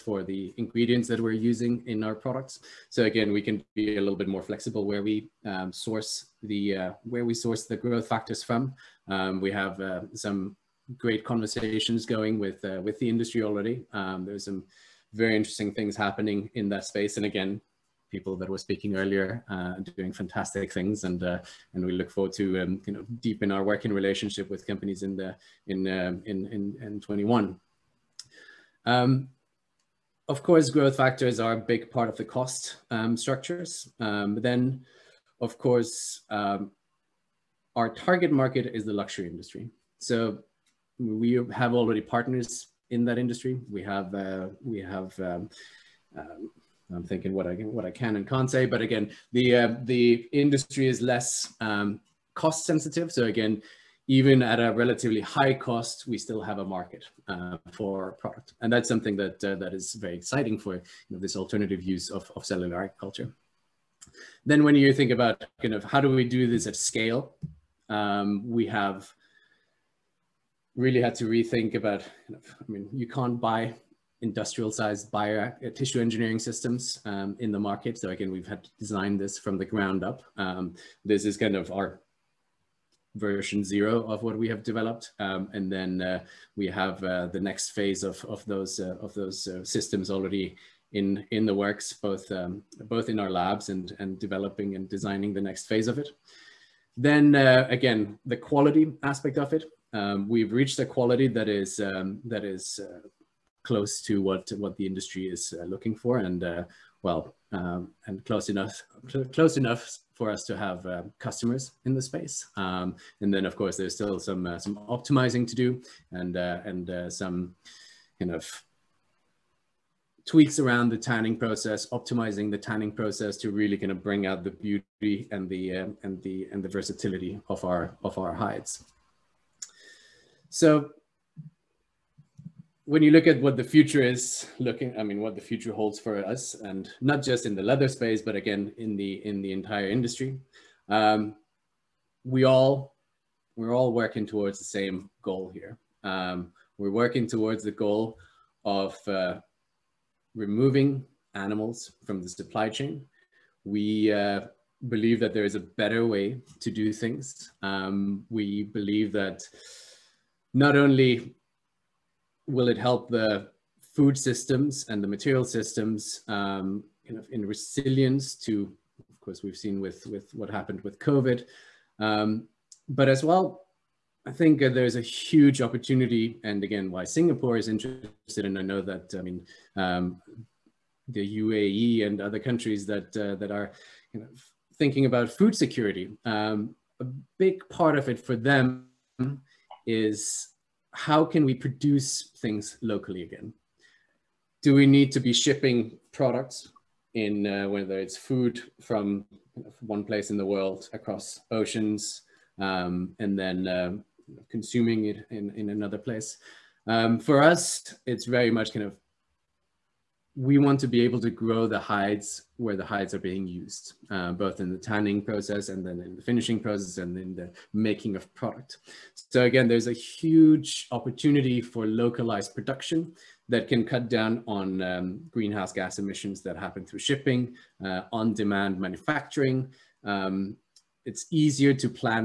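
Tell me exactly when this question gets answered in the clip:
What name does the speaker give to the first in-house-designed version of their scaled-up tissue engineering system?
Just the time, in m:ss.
1:23.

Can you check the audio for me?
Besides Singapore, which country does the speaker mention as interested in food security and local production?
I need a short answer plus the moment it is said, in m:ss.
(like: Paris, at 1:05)
UAE, at 3:01.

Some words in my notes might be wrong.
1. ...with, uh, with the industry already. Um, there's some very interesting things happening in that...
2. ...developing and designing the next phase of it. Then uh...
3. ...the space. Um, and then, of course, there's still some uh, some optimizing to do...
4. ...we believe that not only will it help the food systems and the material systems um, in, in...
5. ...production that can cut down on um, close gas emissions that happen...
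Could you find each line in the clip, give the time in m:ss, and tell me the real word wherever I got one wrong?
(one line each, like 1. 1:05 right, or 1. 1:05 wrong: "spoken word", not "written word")
1. 0:12 right
2. 1:34 right
3. 1:51 right
4. 2:38 right
5. 3:42 wrong: "greenhouse", not "close".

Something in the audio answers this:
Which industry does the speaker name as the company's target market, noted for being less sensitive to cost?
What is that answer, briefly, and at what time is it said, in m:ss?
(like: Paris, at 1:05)
Luxury industry, at 0:38.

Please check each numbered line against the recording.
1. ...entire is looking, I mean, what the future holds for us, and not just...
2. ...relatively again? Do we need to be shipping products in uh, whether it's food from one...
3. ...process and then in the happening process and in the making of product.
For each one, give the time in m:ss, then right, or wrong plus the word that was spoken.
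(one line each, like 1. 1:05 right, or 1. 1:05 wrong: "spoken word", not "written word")
1. 2:13 wrong: "future", not "entire"
2. 3:12 wrong: "locally", not "relatively"
3. 3:35 wrong: "finishing", not "happening".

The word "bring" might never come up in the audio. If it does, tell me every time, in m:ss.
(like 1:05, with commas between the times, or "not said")
2:04.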